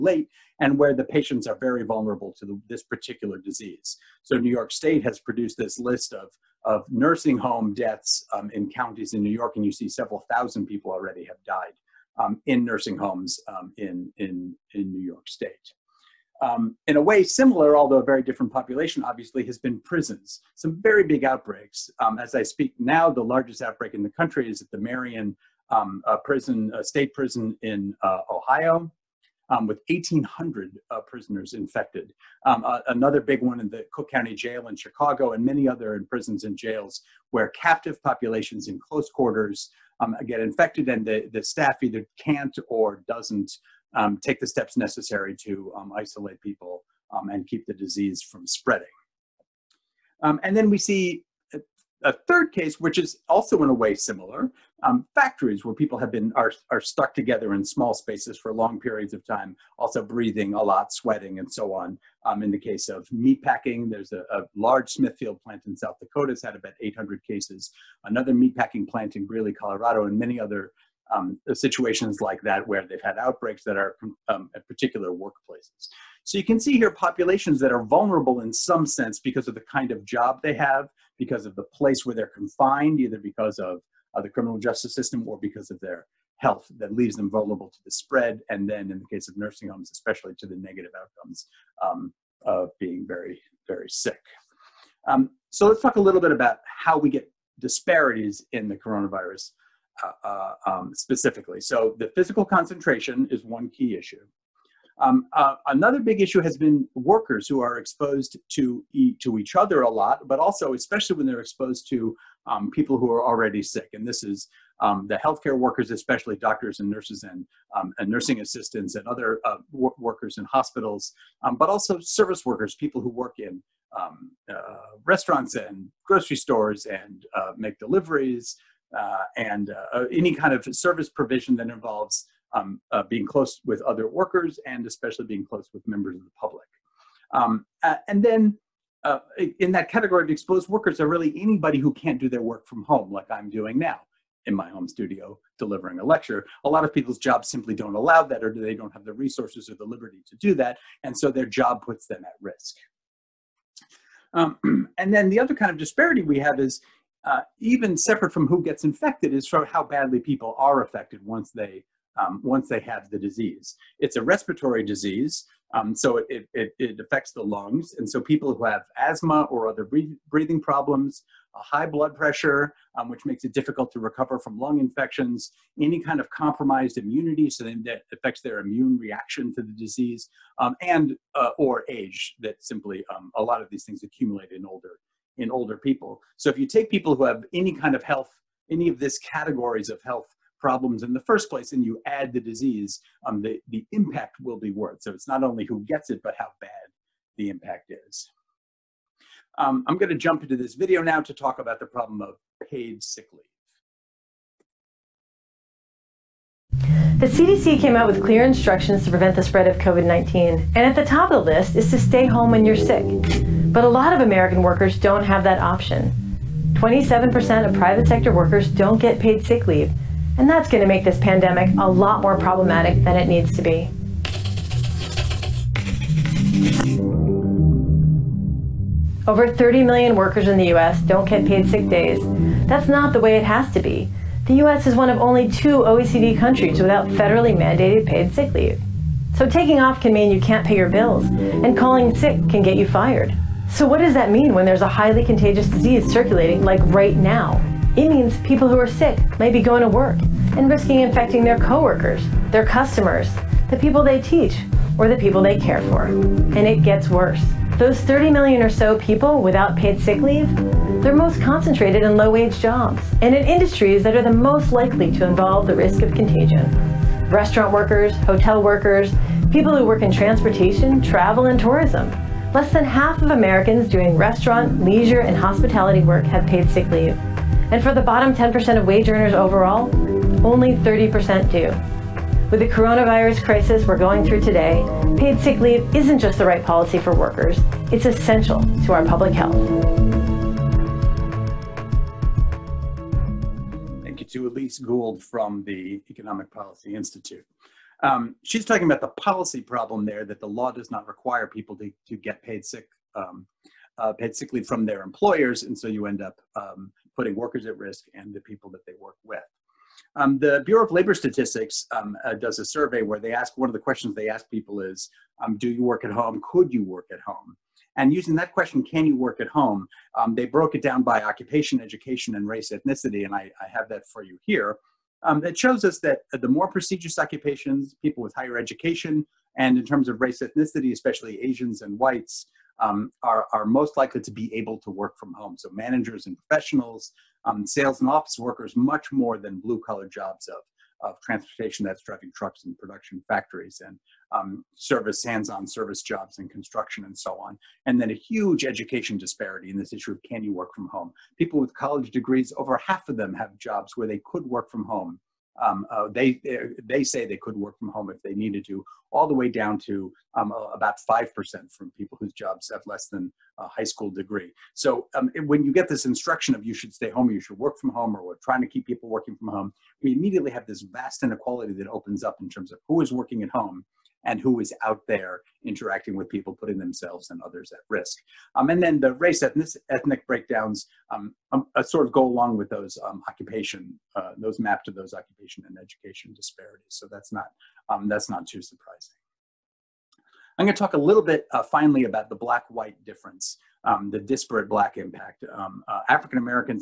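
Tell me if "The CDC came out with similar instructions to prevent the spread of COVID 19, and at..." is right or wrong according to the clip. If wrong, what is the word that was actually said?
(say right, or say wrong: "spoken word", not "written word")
wrong: "clear", not "similar".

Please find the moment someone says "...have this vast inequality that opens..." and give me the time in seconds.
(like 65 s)
370 s.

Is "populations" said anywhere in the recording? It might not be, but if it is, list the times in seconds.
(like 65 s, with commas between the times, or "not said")
18 s, 38 s, 76 s.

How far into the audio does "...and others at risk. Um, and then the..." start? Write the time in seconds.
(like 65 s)
377 s.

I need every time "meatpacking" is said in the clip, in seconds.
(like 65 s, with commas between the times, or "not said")
63 s, 68 s.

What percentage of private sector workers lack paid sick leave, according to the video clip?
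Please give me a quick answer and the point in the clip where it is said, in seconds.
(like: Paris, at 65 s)
27%, at 216 s.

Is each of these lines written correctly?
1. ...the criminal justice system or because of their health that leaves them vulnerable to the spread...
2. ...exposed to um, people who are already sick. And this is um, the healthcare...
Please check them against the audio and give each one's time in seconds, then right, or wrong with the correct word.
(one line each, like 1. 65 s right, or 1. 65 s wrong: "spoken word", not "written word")
1. 84 s right
2. 111 s right.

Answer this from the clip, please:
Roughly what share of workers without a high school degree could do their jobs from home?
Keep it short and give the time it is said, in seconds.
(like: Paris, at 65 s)
5%, at 361 s.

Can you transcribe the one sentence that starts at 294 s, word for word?
Thank you to Elise Gould from the Economic Policy Institute.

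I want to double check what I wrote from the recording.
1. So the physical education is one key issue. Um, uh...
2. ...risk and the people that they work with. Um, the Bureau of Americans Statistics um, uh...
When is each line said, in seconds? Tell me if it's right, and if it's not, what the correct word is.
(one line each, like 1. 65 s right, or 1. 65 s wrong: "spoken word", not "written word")
1. 101 s wrong: "concentration", not "education"
2. 307 s wrong: "Labor", not "Americans".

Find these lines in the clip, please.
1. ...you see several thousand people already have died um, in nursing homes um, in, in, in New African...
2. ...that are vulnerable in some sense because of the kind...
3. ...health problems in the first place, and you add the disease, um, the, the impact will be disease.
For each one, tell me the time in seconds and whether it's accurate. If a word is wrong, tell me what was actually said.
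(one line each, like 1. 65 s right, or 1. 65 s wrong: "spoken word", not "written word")
1. 9 s wrong: "York", not "African"
2. 77 s right
3. 190 s wrong: "worse", not "disease".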